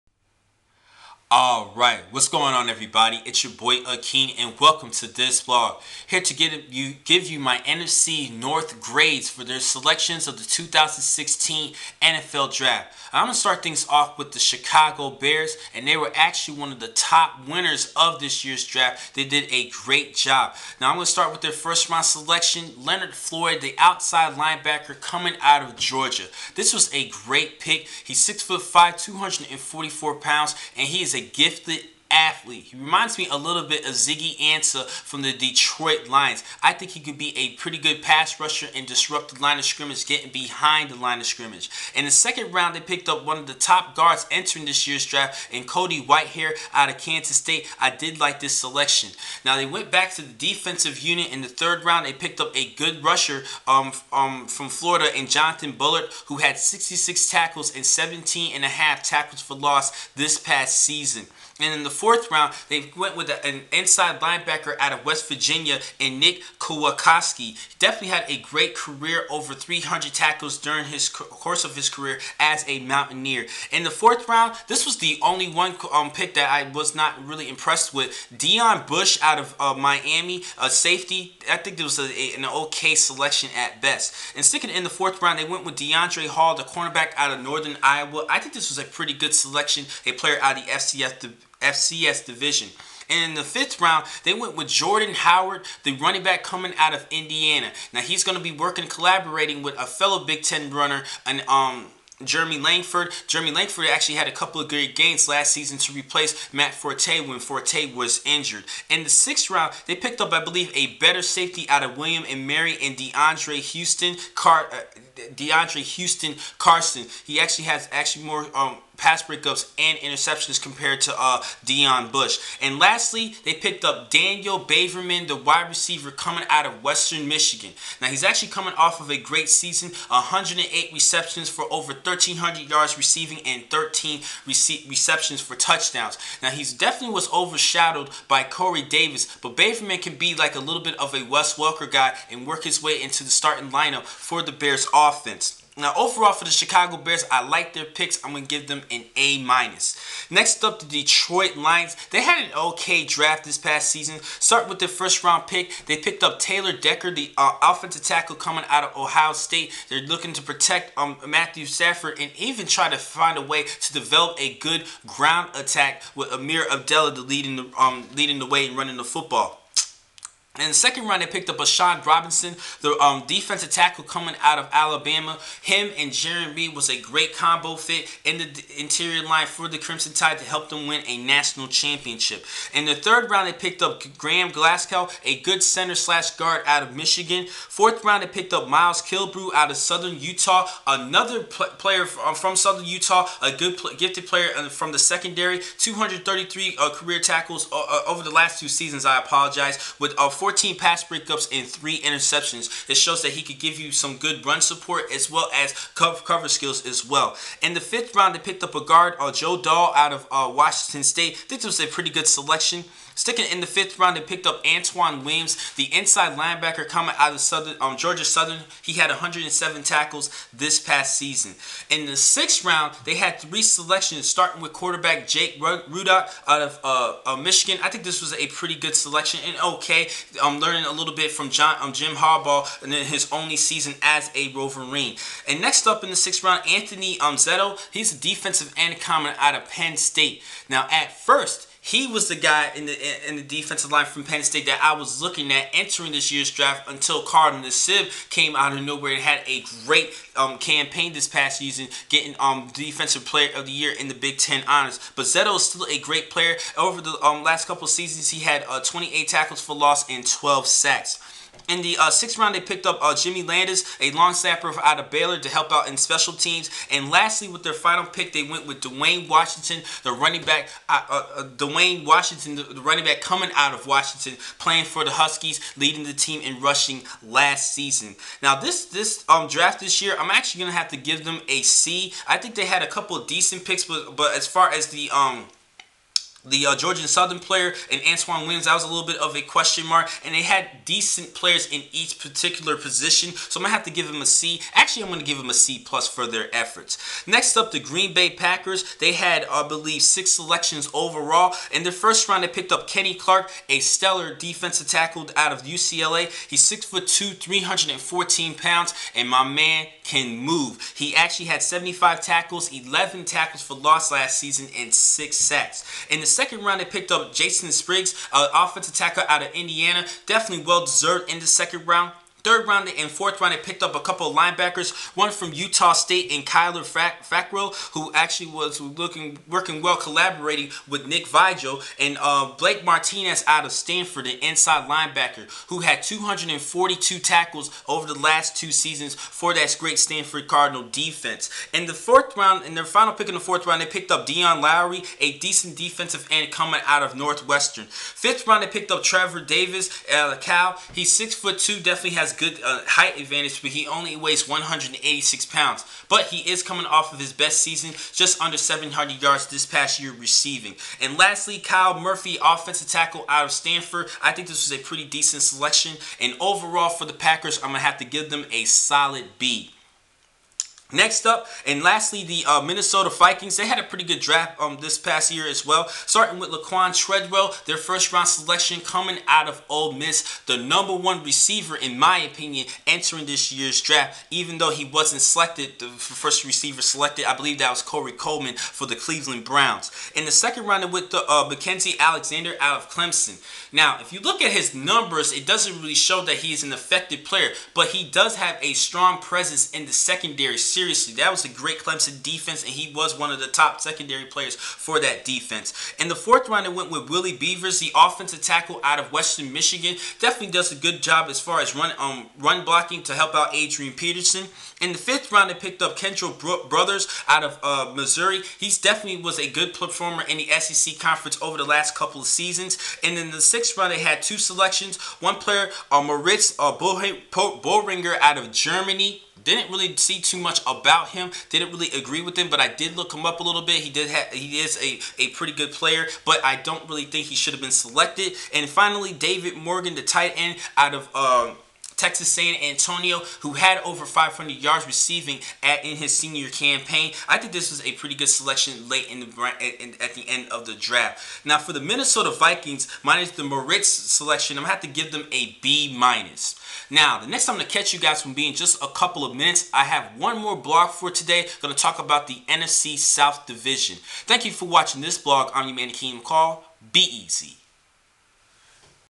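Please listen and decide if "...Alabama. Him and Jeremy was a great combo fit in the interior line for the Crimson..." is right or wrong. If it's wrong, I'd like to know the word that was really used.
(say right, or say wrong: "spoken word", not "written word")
right.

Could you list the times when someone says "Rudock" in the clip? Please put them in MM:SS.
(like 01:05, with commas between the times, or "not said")
03:45.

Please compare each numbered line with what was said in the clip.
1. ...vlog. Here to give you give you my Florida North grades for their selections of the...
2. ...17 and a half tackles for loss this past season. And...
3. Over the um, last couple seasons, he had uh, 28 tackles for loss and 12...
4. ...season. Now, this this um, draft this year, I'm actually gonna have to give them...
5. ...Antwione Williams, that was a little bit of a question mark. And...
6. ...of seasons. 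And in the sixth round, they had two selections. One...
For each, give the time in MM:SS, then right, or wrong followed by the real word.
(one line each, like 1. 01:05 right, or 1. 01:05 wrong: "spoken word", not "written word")
1. 00:05 wrong: "NFC", not "Florida"
2. 00:57 right
3. 04:16 right
4. 04:37 right
5. 04:48 right
6. 07:02 right.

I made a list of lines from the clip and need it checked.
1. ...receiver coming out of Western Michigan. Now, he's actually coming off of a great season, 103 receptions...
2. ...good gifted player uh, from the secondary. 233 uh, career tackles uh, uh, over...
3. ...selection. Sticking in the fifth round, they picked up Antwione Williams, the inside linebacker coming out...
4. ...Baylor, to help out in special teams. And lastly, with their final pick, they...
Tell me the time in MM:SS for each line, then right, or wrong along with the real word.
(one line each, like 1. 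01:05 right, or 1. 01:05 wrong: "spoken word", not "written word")
1. 02:05 wrong: "108", not "103"
2. 03:13 right
3. 03:32 right
4. 04:25 right.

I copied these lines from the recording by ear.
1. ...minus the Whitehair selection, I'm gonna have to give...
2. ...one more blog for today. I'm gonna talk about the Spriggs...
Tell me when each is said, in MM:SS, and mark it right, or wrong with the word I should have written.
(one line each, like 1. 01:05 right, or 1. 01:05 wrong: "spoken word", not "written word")
1. 07:33 wrong: "Moritz", not "Whitehair"
2. 07:40 wrong: "NFC", not "Spriggs".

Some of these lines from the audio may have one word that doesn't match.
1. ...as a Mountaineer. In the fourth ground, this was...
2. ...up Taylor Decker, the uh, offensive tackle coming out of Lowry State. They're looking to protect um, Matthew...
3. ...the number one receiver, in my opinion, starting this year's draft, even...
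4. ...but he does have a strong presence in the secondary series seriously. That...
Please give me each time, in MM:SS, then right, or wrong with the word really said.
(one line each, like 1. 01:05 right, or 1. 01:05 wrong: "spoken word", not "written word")
1. 01:12 wrong: "round", not "ground"
2. 02:36 wrong: "Ohio", not "Lowry"
3. 06:20 wrong: "entering", not "starting"
4. 06:37 right.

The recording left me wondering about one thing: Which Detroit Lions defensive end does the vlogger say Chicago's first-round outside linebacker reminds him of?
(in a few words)
Ziggy Ansah.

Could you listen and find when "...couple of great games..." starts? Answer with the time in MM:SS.
01:44.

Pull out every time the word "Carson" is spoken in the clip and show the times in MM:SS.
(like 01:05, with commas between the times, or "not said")
01:56.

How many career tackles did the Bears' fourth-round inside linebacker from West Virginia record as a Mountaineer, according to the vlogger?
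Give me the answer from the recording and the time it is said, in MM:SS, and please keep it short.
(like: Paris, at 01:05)
over 300, at 01:09.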